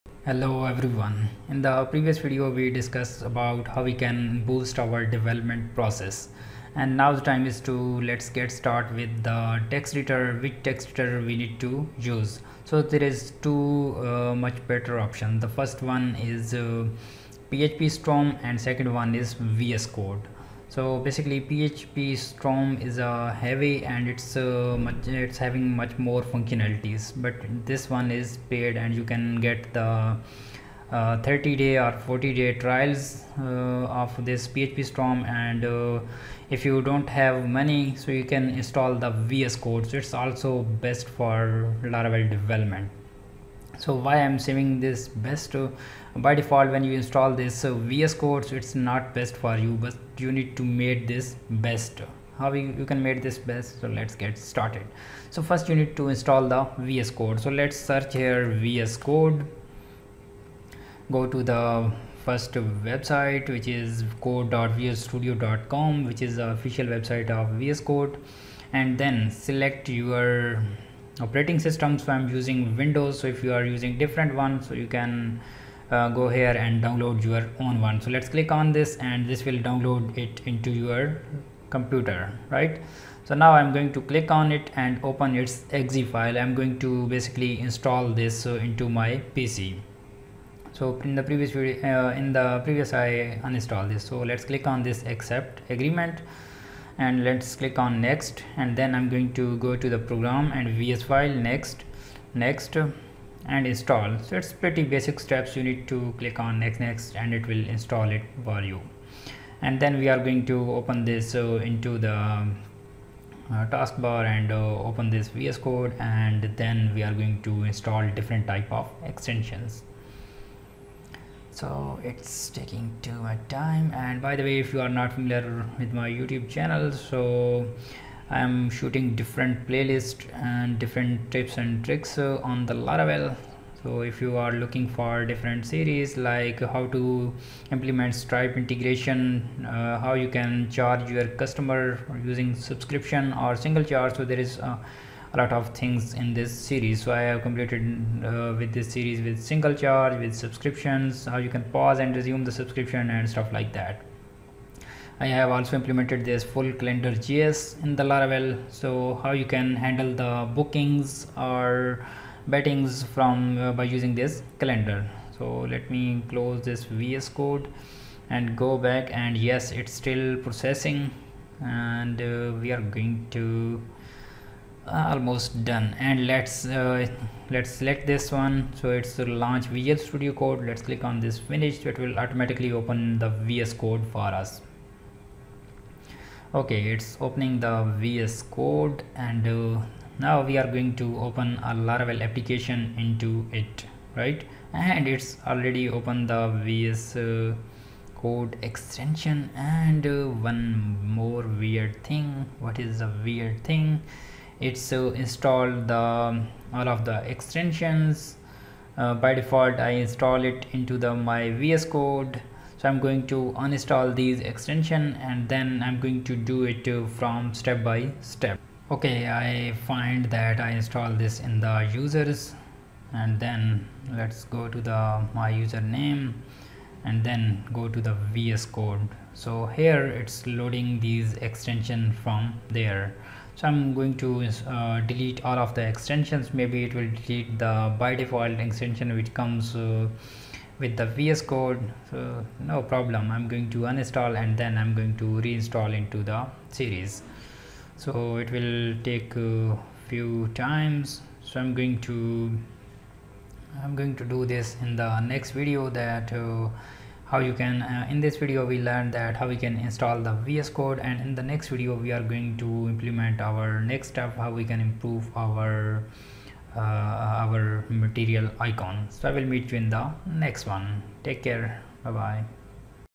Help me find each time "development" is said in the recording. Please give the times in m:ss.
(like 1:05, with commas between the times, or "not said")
0:05, 0:42.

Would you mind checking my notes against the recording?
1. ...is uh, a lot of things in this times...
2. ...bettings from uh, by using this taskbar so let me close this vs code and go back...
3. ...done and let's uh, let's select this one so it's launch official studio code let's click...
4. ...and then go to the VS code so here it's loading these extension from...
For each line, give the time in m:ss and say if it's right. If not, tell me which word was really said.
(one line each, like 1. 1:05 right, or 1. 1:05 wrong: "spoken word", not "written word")
1. 2:24 wrong: "series", not "times"
2. 2:42 wrong: "calendar", not "taskbar"
3. 2:55 wrong: "visual", not "official"
4. 3:47 right.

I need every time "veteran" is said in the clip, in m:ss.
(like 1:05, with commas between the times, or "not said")
not said.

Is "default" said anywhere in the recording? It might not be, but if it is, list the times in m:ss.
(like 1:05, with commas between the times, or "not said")
0:46, 3:29, 3:58.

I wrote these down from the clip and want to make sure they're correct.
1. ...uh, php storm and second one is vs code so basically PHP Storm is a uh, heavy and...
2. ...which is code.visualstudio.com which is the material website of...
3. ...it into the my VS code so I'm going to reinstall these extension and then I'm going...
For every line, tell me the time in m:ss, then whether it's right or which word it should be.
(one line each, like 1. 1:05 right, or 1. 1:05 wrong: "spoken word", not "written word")
1. 0:16 right
2. 1:03 wrong: "official", not "material"
3. 3:30 wrong: "uninstall", not "reinstall".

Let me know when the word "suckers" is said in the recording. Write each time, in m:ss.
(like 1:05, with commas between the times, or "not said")
not said.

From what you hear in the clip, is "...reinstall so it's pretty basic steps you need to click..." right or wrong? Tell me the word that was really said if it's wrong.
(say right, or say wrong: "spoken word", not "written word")
wrong: "install", not "reinstall".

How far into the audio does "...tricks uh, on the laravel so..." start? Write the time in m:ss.
2:11.